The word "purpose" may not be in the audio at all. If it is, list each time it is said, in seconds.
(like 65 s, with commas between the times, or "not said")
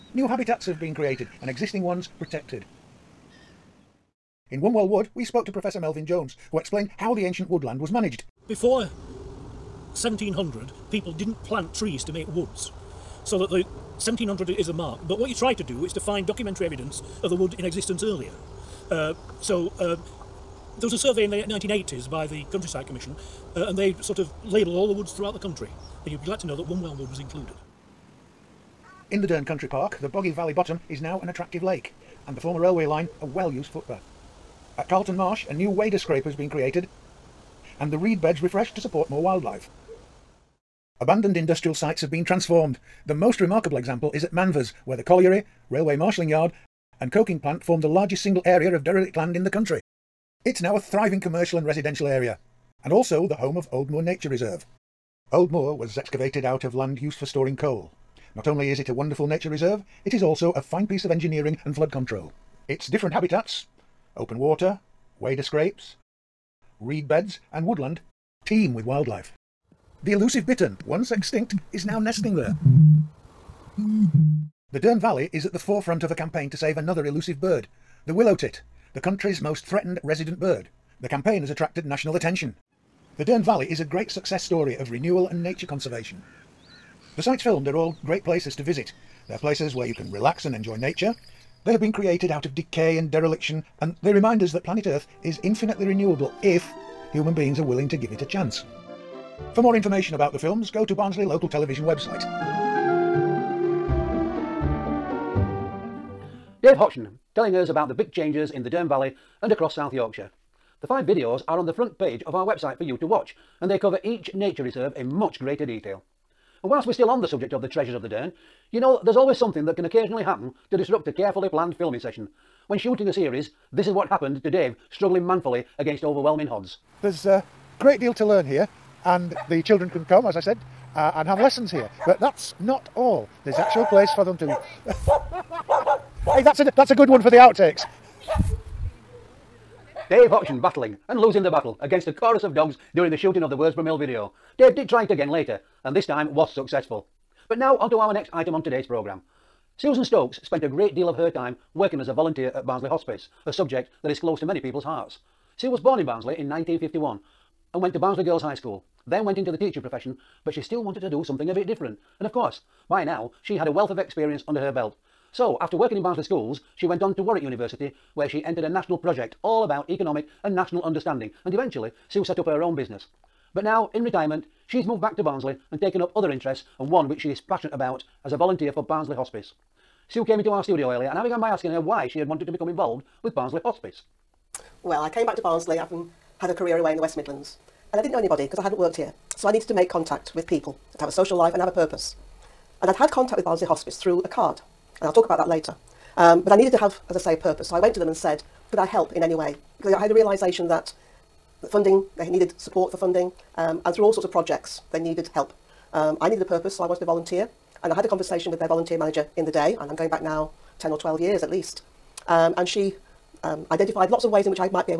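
191 s, 197 s, 206 s.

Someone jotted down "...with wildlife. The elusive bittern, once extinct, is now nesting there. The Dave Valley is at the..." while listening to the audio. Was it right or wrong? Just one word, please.
wrong.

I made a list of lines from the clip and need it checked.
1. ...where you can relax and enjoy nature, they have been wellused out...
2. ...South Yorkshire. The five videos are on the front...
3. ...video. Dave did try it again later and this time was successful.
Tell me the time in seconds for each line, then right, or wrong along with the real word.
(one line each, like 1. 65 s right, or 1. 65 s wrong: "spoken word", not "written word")
1. 89 s wrong: "created", not "wellused"
2. 109 s right
3. 143 s right.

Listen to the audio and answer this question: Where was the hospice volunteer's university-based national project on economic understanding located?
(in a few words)
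Warwick University.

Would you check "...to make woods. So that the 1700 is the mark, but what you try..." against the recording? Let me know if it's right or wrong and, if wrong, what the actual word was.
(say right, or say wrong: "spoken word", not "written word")
right.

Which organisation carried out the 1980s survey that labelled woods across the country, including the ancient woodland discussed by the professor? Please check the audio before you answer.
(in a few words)
Countryside Commission.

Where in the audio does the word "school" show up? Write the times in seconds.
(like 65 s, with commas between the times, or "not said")
158 s, 166 s.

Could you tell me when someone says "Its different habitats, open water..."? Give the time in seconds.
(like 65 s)
62 s.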